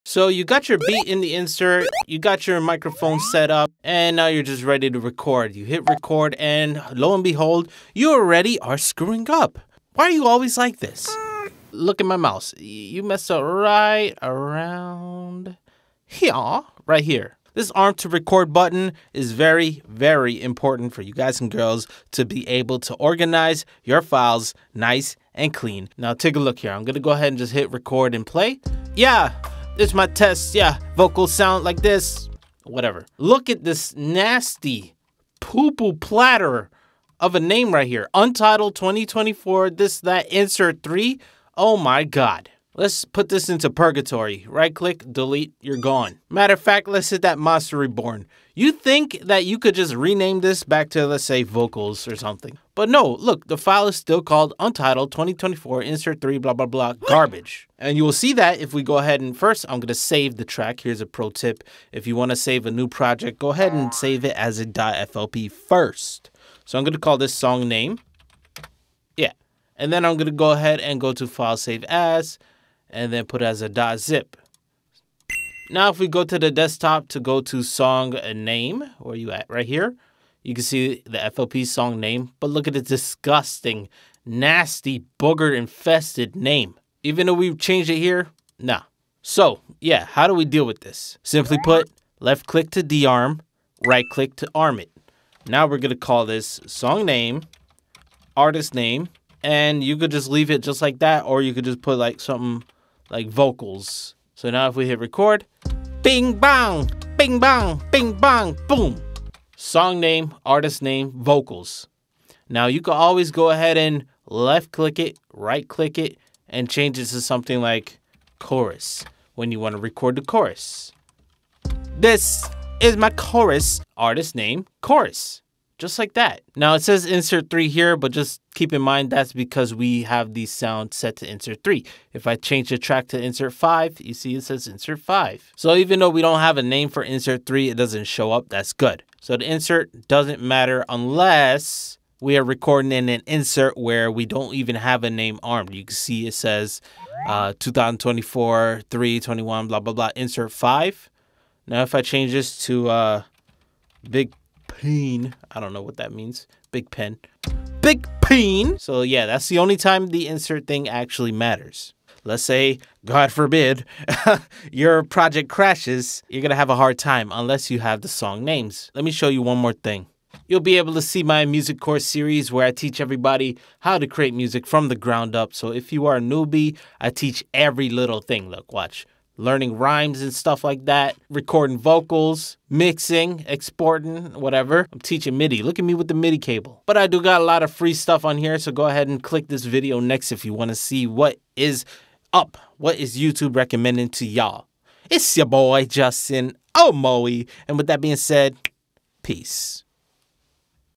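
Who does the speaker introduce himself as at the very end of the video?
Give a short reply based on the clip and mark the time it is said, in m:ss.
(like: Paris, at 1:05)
Justin Omoi, at 3:15.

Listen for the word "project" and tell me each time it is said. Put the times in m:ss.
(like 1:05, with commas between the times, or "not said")
1:02, 2:45.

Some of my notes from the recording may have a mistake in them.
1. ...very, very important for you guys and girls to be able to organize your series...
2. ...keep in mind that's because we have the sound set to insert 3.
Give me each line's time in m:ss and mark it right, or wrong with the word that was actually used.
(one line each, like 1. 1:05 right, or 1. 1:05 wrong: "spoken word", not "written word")
1. 0:19 wrong: "files", not "series"
2. 2:08 right.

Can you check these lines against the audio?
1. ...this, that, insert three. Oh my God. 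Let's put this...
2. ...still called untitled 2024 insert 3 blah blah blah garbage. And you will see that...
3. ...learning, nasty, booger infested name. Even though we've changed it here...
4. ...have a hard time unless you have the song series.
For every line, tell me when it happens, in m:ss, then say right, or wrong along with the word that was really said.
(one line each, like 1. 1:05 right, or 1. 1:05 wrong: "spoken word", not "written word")
1. 0:39 right
2. 0:53 right
3. 1:22 wrong: "disgusting", not "learning"
4. 2:46 wrong: "names", not "series".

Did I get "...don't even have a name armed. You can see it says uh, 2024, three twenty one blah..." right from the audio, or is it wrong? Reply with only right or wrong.
right.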